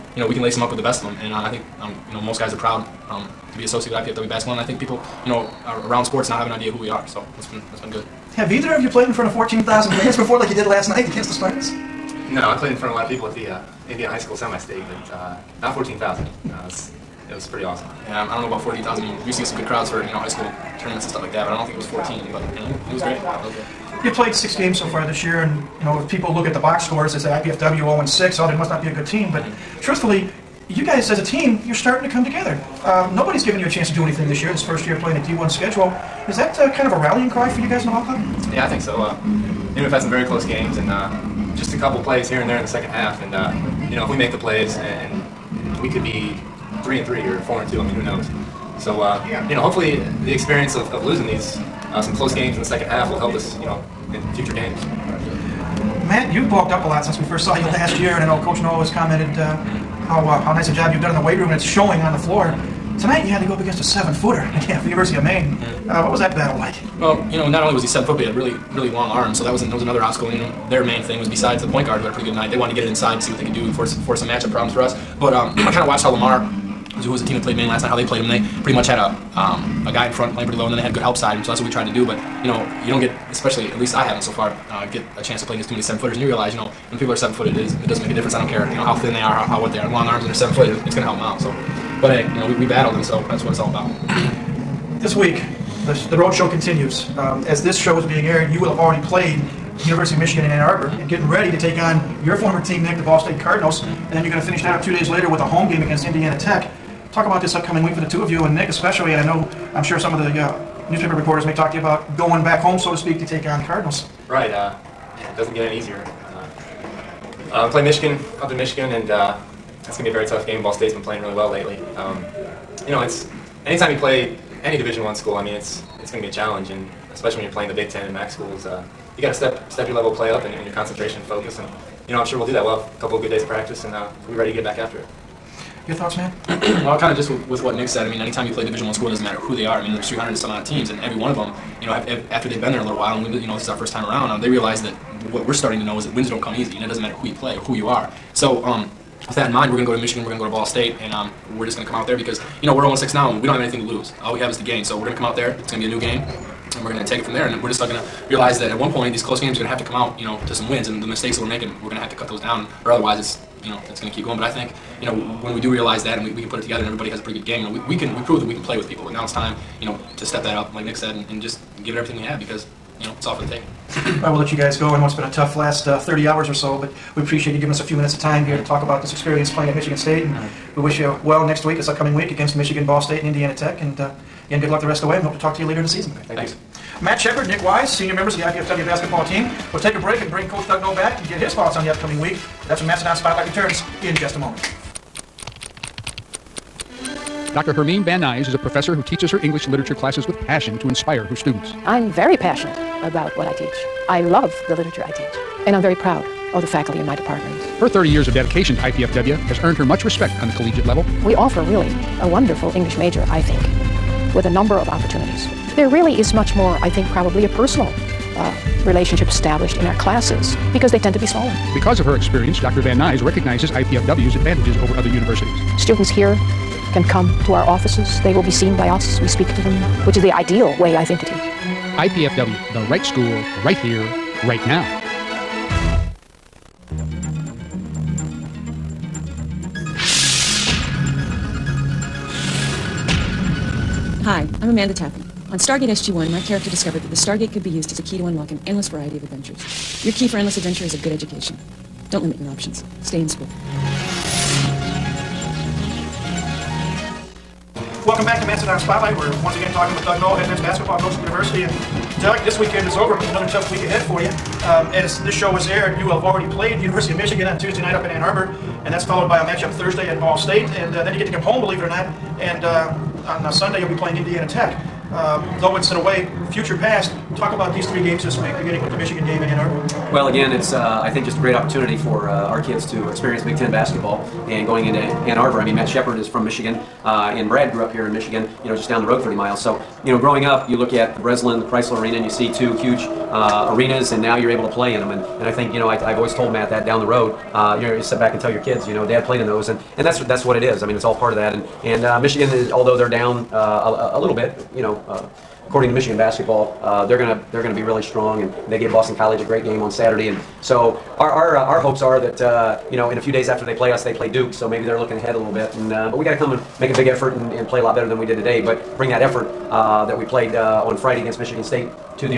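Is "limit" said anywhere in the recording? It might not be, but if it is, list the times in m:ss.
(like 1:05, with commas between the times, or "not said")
4:12.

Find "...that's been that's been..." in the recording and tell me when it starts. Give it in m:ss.
0:07.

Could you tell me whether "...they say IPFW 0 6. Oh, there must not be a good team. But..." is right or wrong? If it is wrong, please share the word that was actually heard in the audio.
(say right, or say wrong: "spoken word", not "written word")
right.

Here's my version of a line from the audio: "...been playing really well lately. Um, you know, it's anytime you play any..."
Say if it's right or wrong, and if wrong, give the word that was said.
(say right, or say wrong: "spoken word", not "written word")
right.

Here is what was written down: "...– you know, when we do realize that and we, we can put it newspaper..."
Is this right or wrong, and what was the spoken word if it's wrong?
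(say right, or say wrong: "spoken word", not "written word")
wrong: "together", not "newspaper".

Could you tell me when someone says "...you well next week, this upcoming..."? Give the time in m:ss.
3:00.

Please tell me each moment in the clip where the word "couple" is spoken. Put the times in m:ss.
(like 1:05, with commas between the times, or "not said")
0:41, 2:13.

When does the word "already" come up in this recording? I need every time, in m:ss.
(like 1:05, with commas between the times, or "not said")
1:38, 4:26.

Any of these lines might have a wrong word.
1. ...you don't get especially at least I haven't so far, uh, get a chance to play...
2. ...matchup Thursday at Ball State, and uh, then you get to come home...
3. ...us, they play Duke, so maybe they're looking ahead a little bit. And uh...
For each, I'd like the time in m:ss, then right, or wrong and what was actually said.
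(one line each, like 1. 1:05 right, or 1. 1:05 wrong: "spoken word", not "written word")
1. 1:22 right
2. 4:29 right
3. 5:13 right.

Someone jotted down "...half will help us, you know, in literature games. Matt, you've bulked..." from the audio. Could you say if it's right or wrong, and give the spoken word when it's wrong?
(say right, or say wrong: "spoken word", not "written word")
wrong: "future", not "literature".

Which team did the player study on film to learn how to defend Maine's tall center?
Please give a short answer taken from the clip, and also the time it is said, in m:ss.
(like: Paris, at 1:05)
Lamar, at 1:16.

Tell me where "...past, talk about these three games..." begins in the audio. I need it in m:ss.
4:36.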